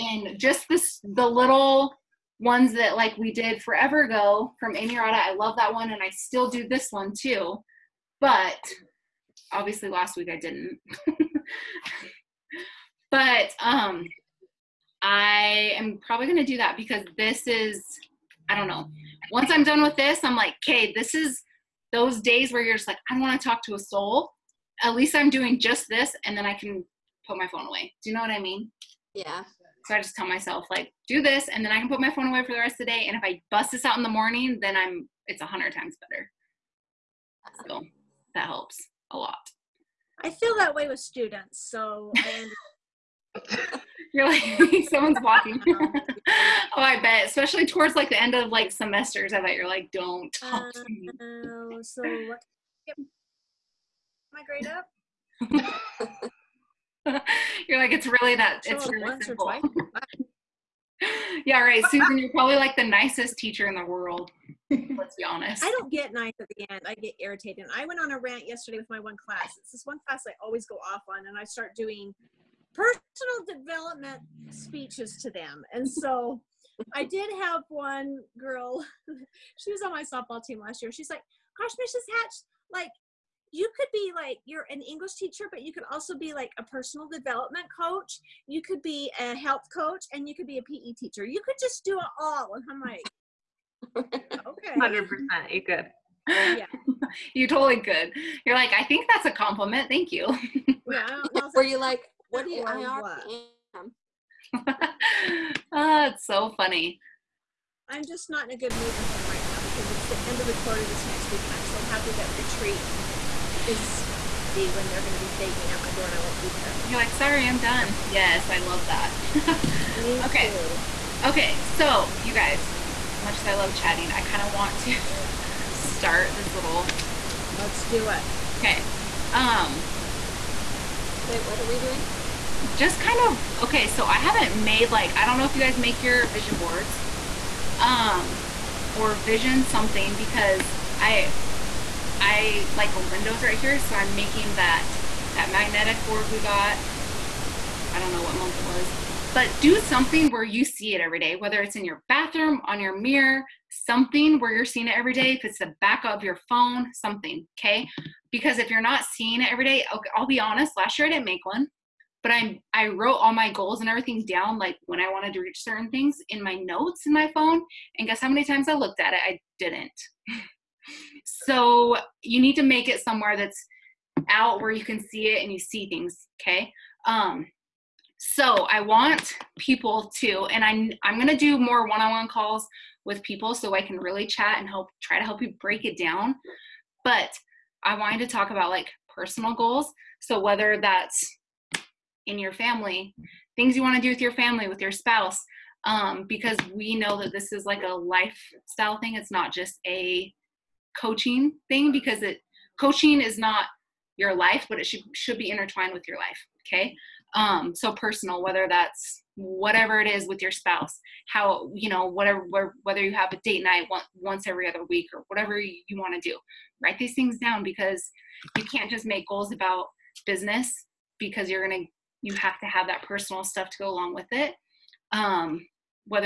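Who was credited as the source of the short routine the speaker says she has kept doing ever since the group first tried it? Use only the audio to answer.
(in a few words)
Amy Rada.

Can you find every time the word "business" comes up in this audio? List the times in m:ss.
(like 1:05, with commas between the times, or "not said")
3:40.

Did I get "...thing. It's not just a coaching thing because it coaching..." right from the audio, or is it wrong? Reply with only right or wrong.
right.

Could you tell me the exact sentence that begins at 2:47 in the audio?
And guess how many times I looked at it?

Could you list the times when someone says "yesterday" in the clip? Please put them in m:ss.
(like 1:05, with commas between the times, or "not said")
1:08.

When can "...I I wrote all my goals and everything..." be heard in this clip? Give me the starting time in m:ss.
2:42.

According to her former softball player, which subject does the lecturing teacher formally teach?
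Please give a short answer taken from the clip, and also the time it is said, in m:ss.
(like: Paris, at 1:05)
English, at 1:24.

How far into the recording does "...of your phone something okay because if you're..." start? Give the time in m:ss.
2:36.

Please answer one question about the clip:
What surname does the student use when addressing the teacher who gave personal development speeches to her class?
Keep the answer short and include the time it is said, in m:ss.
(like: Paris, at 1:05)
Mrs. Hatch, at 1:21.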